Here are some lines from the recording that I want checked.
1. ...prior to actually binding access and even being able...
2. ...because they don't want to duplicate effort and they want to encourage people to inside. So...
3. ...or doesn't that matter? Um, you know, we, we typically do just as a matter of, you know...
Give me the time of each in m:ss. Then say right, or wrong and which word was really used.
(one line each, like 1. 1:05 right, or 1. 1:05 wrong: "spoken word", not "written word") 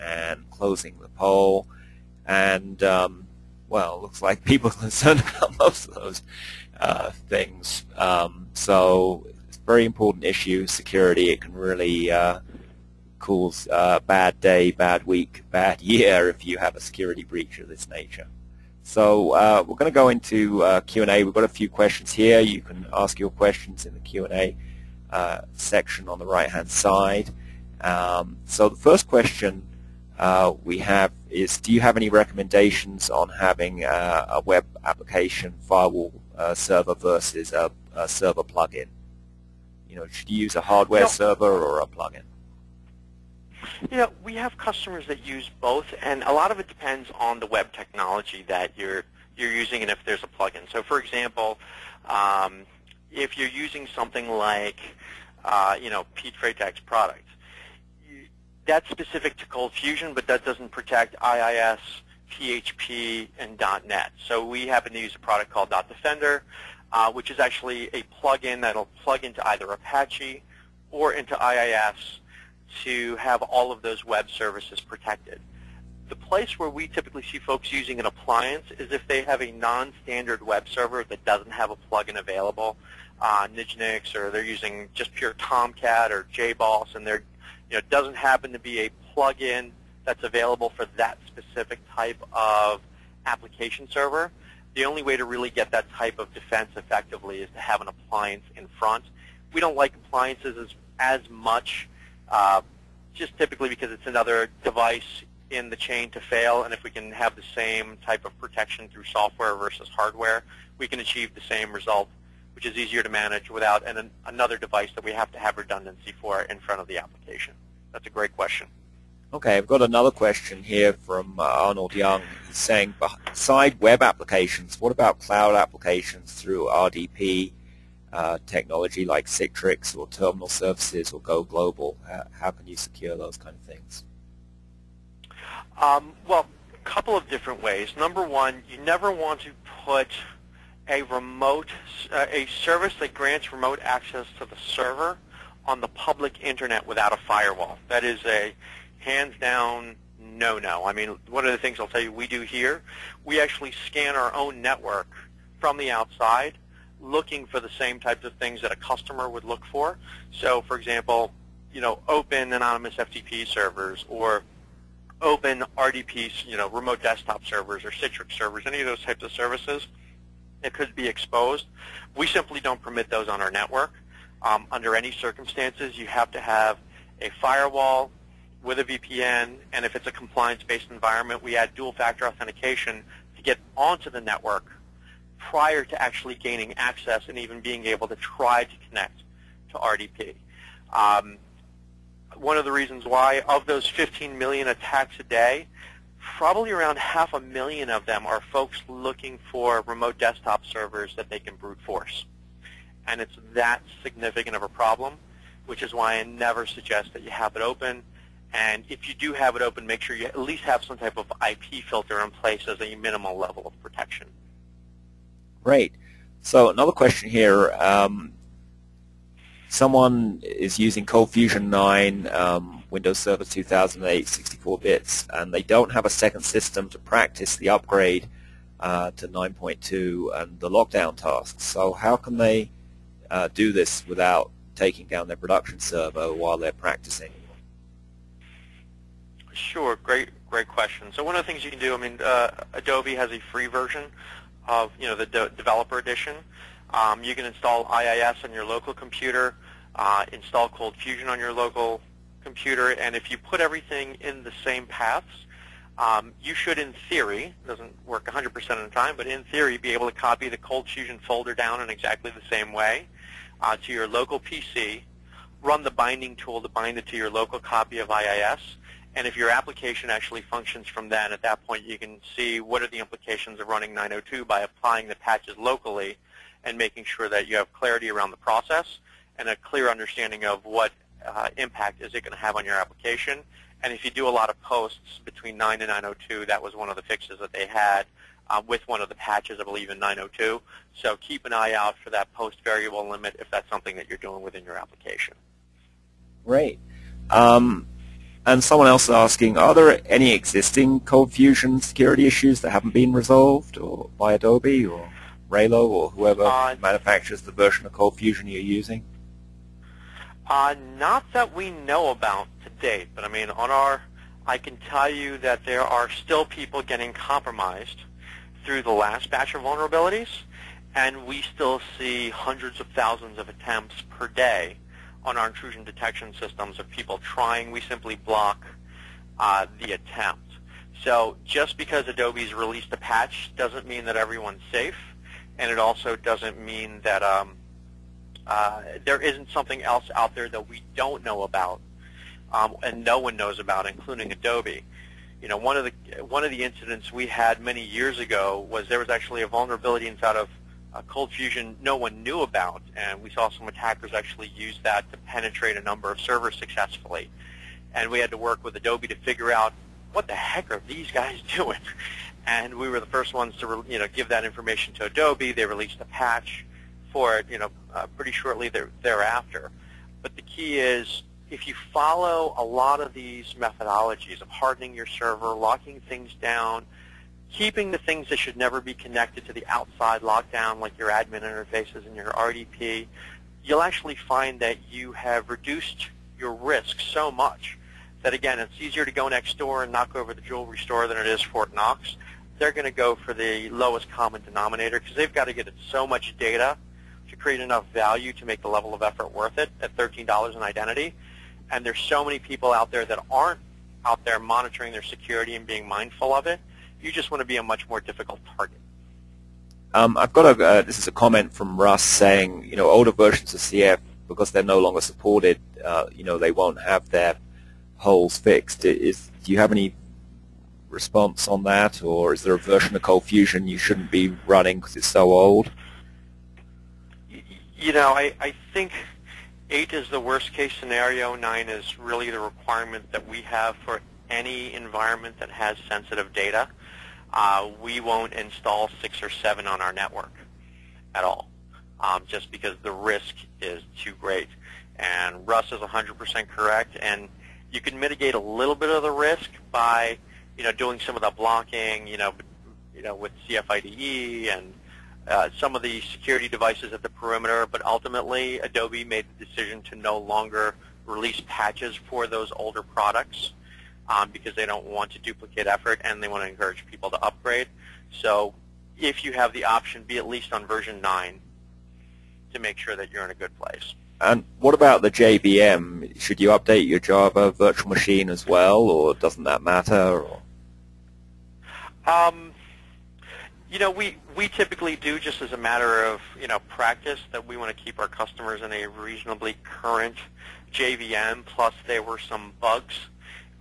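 1. 3:05 wrong: "gaining", not "binding"
2. 7:44 wrong: "upgrade", not "inside"
3. 7:58 right.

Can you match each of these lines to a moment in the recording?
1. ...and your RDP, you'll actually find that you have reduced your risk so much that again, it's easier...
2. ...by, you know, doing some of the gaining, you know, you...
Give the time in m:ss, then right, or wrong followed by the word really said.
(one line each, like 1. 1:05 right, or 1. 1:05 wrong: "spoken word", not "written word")
1. 6:22 right
2. 7:29 wrong: "blocking", not "gaining".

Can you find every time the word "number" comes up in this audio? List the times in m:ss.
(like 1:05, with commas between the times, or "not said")
2:17, 5:55.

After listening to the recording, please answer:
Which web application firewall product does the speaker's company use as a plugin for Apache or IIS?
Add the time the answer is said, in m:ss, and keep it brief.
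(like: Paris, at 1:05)
dotDefender, at 1:05.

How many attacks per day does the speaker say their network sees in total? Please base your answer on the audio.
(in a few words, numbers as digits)
15 million.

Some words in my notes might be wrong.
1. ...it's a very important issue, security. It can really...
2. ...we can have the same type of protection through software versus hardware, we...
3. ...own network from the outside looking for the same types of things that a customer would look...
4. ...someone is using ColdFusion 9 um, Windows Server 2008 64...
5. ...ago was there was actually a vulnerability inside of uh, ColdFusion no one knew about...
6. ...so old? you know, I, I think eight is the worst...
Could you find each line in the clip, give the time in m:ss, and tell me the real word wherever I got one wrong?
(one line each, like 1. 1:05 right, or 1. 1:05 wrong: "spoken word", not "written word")
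1. 0:09 right
2. 1:46 right
3. 2:34 right
4. 3:39 right
5. 5:48 right
6. 7:05 right.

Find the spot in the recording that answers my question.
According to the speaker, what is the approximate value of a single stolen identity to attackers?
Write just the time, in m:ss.
6:39.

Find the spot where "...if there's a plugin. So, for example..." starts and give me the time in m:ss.
0:49.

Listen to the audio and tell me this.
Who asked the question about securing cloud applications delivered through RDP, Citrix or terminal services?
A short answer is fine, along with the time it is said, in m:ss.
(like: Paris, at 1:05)
Arnold Young, at 2:01.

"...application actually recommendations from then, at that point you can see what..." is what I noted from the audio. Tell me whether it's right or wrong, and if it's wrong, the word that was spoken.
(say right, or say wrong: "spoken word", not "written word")
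wrong: "functions", not "recommendations".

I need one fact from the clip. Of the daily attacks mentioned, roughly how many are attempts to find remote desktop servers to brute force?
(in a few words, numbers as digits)
half a million.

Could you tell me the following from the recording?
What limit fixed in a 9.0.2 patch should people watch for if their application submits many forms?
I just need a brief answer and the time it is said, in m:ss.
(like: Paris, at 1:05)
post variable limit, at 4:52.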